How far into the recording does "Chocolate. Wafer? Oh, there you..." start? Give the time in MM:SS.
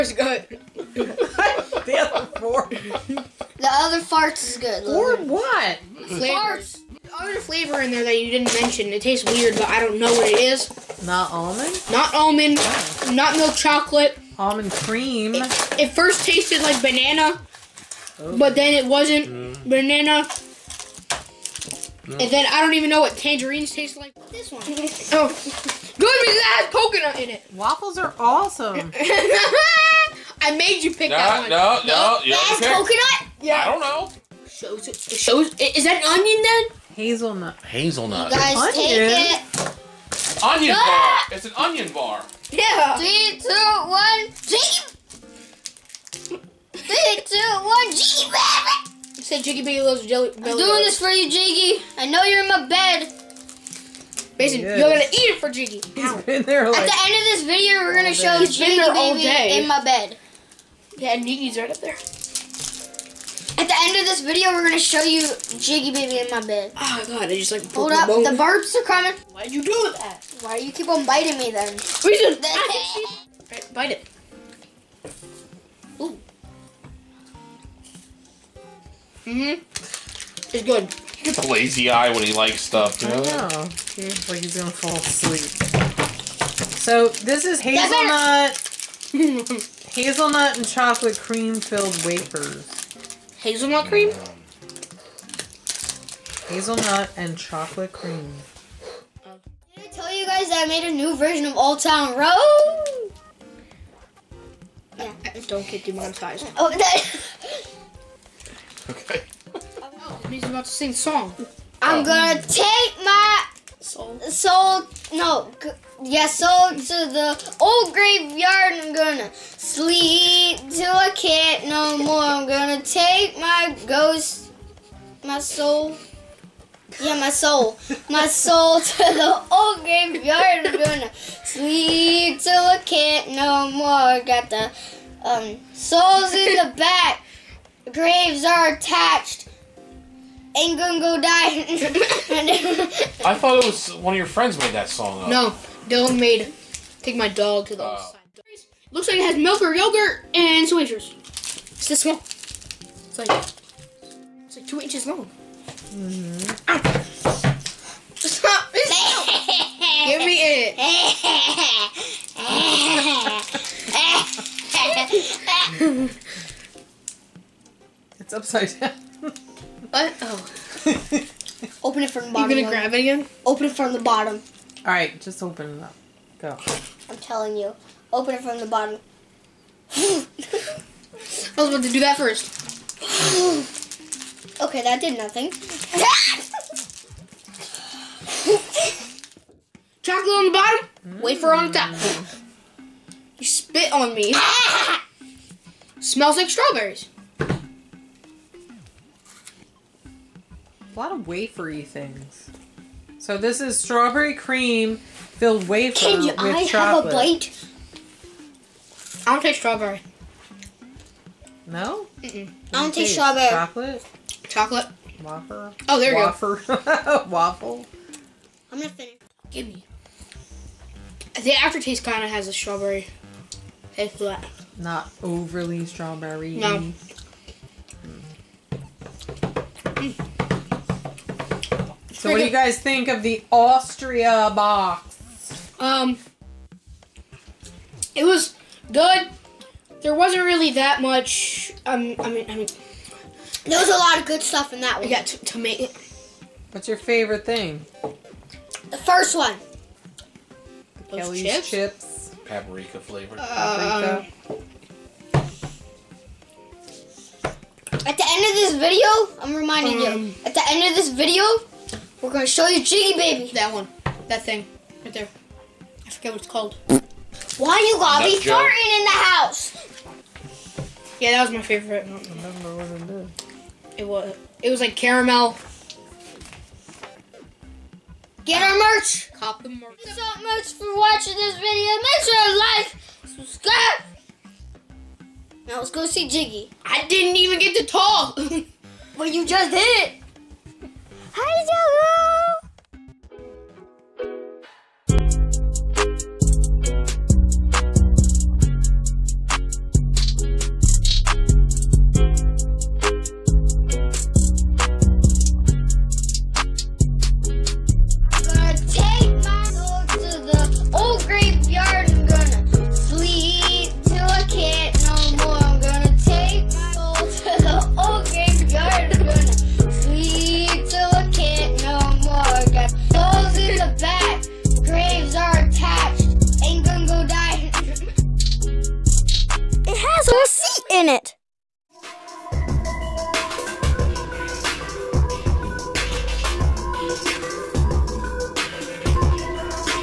03:34.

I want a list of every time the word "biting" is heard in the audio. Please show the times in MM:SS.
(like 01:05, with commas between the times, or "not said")
01:11.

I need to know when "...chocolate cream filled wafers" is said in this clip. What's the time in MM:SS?
01:30.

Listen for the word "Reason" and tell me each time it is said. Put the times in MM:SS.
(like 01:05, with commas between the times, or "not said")
01:11.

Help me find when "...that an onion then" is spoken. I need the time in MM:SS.
00:35.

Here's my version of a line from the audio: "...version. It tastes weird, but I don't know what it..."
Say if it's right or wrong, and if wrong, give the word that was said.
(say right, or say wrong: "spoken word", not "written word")
wrong: "mention", not "version".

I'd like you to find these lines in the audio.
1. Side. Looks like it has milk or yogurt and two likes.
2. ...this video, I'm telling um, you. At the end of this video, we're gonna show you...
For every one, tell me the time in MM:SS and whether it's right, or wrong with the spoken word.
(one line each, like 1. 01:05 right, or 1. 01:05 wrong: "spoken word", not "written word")
1. 02:28 wrong: "inches", not "likes"
2. 04:18 wrong: "reminding", not "telling".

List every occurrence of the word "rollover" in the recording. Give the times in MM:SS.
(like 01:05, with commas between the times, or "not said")
not said.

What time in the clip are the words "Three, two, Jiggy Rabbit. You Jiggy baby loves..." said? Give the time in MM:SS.
00:46.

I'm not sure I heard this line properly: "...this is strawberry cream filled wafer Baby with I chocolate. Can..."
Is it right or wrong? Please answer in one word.
wrong.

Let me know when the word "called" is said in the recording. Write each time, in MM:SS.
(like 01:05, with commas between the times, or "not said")
04:26.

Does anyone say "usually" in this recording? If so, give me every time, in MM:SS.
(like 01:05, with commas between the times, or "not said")
not said.